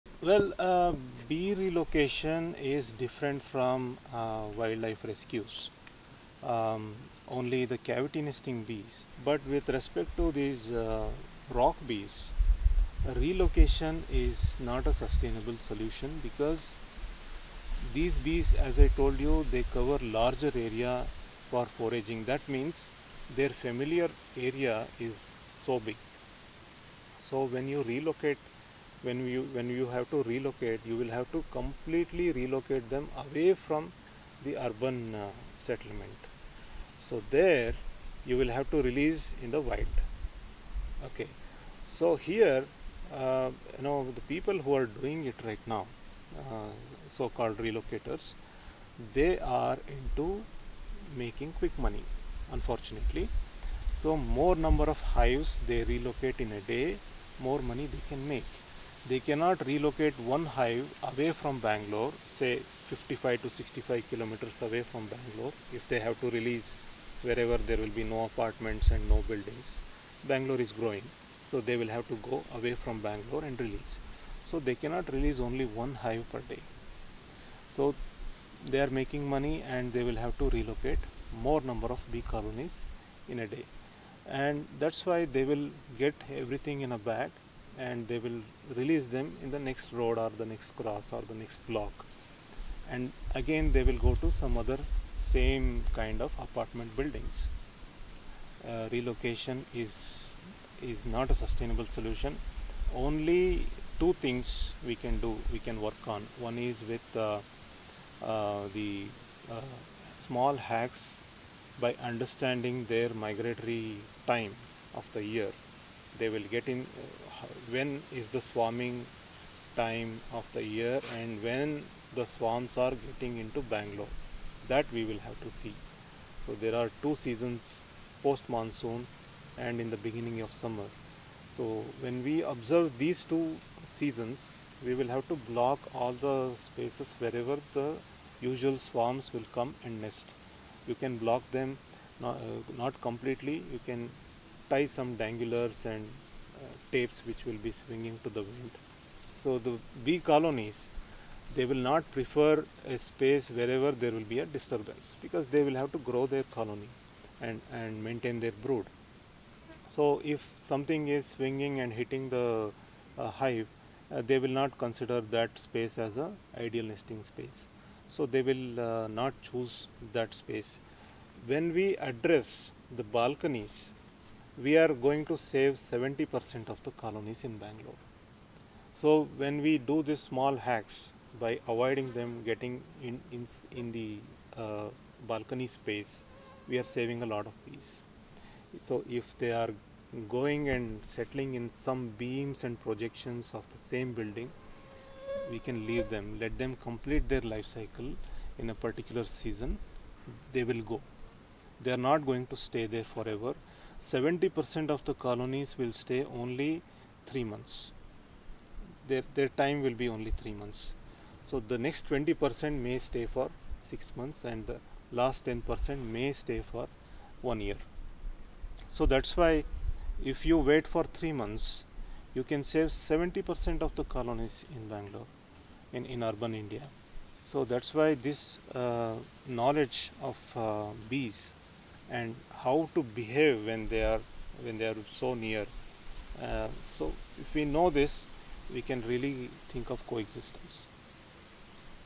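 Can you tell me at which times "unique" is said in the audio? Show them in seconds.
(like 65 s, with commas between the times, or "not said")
not said.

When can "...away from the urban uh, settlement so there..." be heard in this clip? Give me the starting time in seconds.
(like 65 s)
33 s.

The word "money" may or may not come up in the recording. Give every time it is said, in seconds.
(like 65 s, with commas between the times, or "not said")
51 s, 57 s, 79 s.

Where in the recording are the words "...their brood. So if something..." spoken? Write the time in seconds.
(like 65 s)
158 s.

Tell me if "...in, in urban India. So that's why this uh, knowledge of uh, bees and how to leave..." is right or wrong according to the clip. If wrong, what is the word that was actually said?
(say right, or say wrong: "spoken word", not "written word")
wrong: "behave", not "leave".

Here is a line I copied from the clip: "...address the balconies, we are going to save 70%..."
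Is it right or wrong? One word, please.
right.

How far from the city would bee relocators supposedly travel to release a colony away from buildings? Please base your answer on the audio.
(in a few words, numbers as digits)
55 to 65 kilometers.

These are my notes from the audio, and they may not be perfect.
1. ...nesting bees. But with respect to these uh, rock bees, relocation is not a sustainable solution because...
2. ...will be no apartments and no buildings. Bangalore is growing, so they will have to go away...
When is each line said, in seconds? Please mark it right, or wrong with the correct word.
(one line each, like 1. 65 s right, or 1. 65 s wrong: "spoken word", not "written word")
1. 8 s right
2. 67 s right.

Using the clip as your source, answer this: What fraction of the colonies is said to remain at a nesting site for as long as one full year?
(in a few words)
10%.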